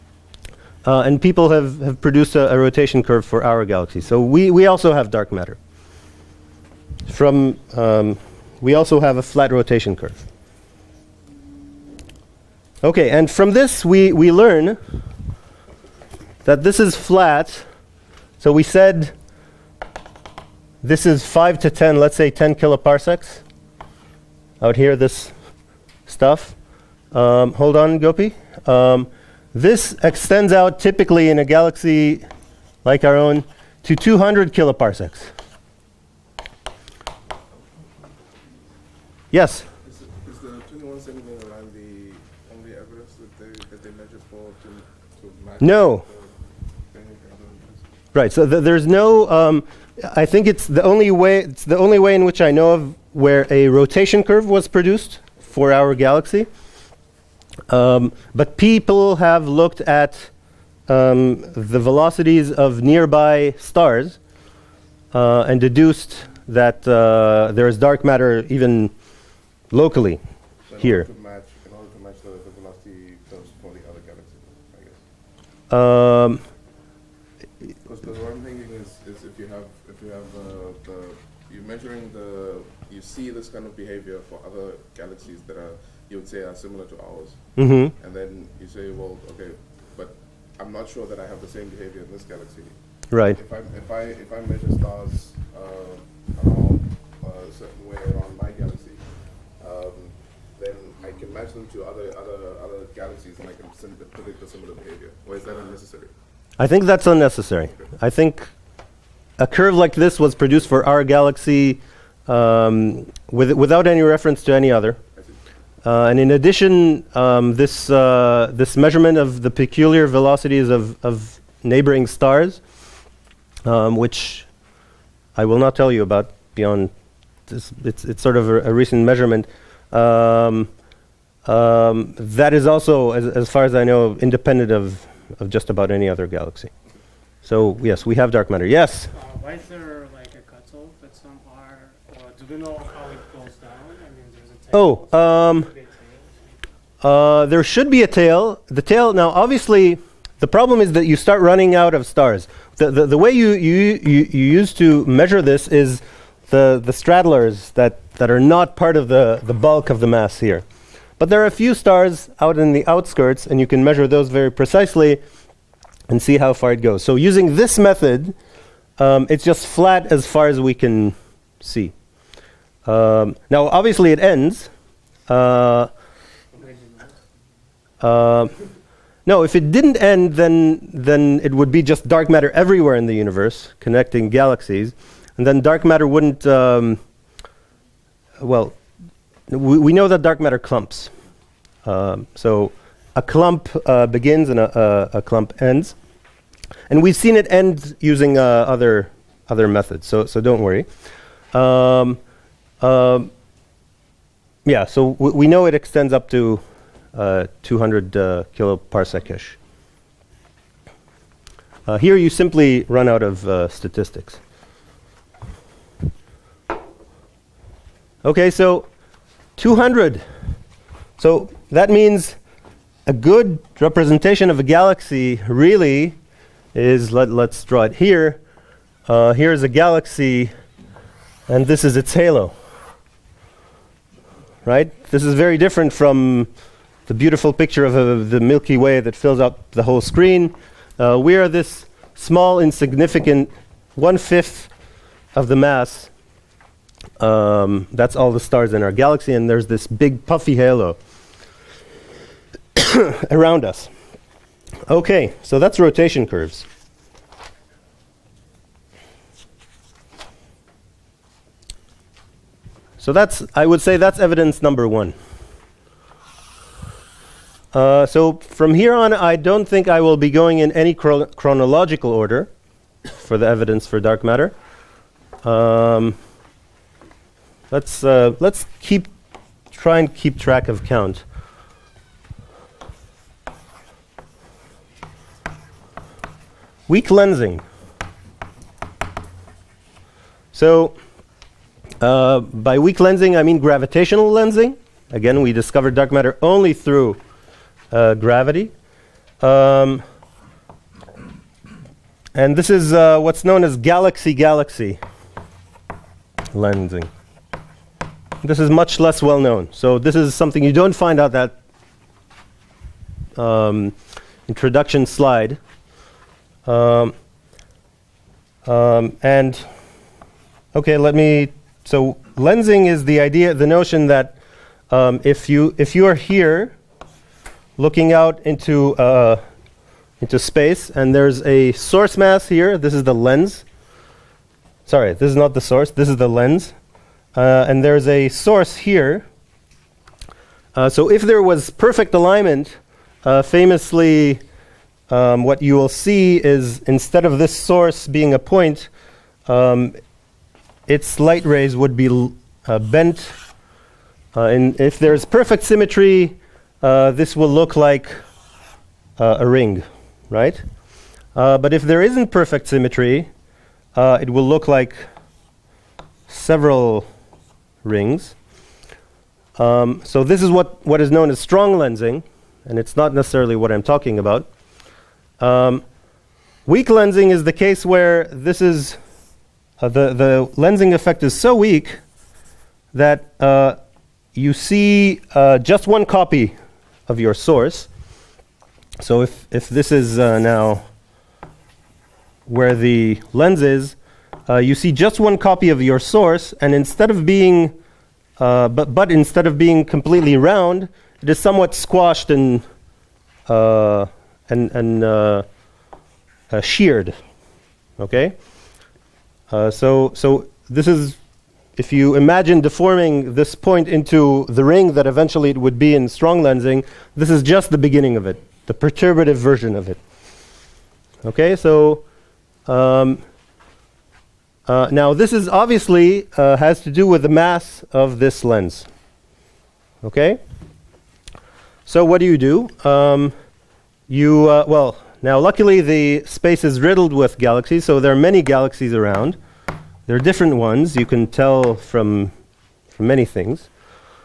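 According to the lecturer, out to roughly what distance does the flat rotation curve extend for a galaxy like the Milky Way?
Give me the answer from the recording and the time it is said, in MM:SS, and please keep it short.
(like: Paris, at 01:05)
200 kiloparsecs, at 00:33.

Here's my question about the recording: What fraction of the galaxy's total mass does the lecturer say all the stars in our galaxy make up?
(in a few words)
one fifth.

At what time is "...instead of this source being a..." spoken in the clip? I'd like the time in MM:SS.
05:46.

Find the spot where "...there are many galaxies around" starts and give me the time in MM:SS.
07:17.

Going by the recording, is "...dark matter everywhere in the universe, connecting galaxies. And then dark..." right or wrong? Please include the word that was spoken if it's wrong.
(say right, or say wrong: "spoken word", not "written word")
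right.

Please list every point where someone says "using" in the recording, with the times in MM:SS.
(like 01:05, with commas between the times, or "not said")
02:47, 03:17.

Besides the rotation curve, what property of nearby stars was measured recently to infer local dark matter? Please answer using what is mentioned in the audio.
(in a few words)
peculiar velocities.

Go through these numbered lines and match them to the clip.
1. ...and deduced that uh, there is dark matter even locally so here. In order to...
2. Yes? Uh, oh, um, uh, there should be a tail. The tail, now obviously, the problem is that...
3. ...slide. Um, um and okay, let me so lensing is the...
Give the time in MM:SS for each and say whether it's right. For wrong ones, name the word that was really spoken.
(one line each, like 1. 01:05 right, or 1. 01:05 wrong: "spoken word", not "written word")
1. 01:05 right
2. 02:18 right
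3. 05:15 right.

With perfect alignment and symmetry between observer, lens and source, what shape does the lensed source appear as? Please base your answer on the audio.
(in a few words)
a ring.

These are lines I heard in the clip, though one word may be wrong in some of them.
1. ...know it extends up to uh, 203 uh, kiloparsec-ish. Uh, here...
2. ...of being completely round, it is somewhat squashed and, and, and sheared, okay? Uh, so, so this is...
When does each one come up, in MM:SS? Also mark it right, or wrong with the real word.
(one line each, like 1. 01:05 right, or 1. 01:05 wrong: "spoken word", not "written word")
1. 03:25 wrong: "200", not "203"
2. 06:39 right.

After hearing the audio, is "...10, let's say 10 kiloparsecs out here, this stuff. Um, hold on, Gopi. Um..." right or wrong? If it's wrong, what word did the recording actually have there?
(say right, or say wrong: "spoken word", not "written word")
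right.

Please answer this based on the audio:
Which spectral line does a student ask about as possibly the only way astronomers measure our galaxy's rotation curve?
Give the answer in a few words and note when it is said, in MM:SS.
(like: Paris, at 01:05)
21 centimeter line, at 00:40.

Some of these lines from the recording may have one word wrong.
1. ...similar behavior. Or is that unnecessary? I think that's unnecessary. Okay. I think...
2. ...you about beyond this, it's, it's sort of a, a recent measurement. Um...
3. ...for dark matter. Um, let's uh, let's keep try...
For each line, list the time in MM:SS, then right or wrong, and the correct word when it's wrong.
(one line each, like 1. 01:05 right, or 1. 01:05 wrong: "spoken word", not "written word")
1. 01:44 right
2. 02:05 right
3. 04:33 right.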